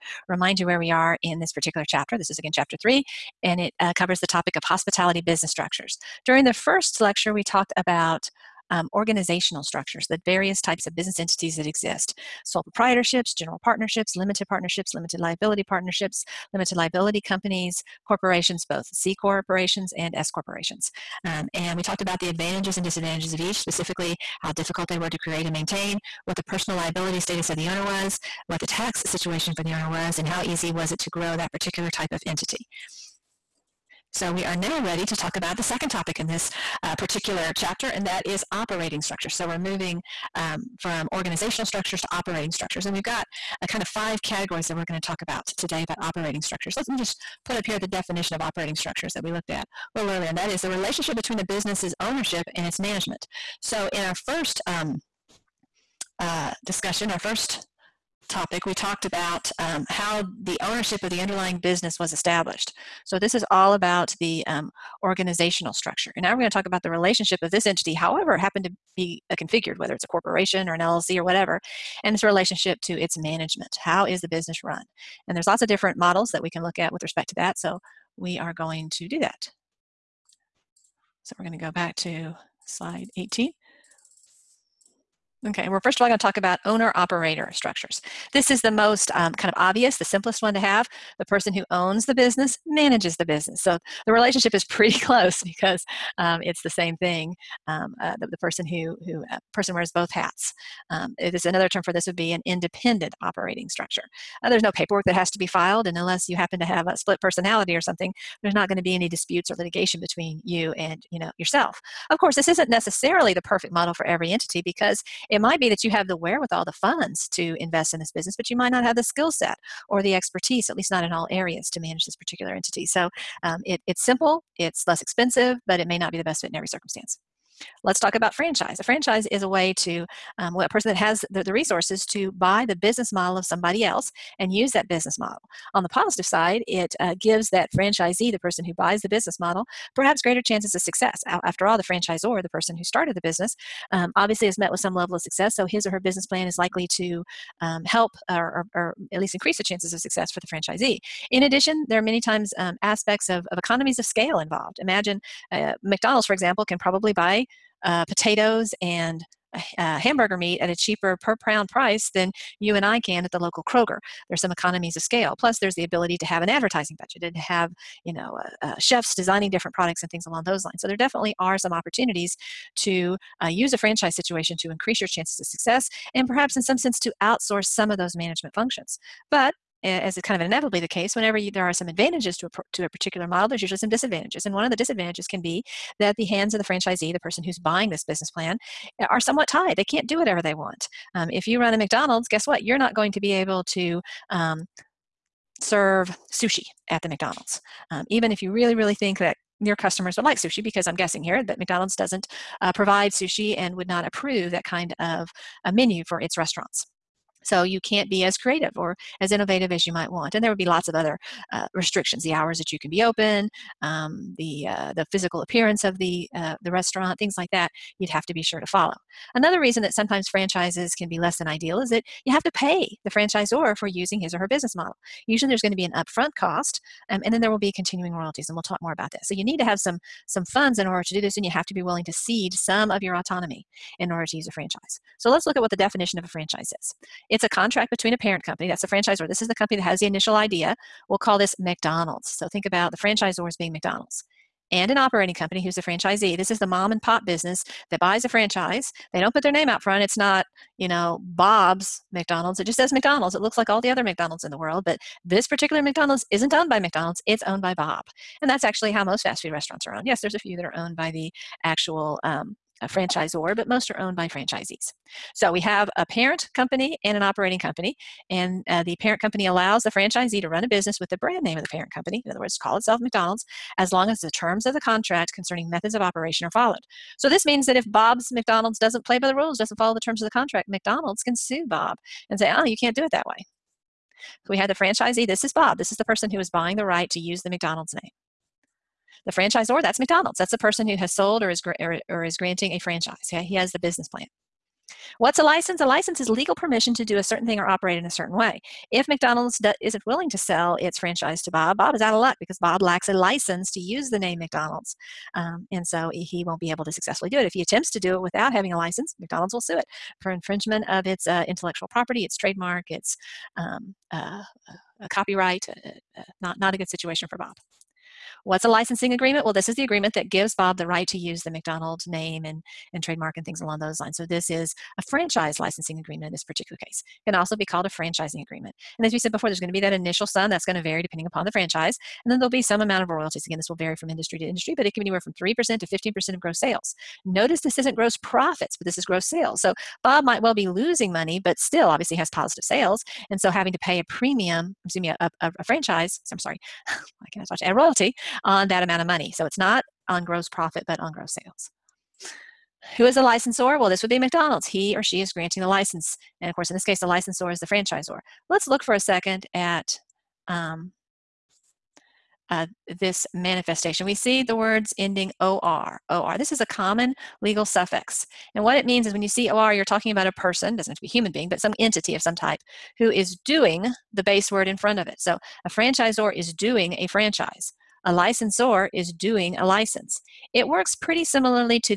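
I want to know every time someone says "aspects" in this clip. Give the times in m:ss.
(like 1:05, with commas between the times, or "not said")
2:32.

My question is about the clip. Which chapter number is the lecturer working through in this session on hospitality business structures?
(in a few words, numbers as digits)
3.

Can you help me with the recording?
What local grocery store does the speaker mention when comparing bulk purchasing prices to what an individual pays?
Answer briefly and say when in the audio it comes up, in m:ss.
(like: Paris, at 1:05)
Kroger, at 2:43.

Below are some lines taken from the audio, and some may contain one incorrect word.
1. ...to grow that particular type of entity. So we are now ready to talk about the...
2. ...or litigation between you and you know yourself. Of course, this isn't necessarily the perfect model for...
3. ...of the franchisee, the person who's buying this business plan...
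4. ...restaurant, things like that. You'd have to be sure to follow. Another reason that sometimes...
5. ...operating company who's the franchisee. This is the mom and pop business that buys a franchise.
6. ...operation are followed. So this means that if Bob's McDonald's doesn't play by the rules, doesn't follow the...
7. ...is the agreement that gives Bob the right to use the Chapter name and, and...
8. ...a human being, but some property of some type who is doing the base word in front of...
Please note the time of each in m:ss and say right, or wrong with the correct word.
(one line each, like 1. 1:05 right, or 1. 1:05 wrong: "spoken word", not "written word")
1. 0:30 right
2. 1:49 right
3. 3:06 right
4. 3:36 right
5. 4:04 right
6. 4:36 right
7. 5:19 wrong: "McDonald", not "Chapter"
8. 6:11 wrong: "entity", not "property".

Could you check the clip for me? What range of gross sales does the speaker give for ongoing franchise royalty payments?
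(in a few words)
3% to 15%.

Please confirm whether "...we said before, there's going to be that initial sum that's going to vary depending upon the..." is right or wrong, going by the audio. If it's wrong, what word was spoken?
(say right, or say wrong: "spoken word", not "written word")
right.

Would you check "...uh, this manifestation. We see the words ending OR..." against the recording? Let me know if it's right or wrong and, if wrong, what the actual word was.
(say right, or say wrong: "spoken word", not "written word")
right.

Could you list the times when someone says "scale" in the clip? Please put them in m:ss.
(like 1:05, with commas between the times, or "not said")
2:34, 2:45.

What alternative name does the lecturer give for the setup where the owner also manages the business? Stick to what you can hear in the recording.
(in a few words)
independent operating structure.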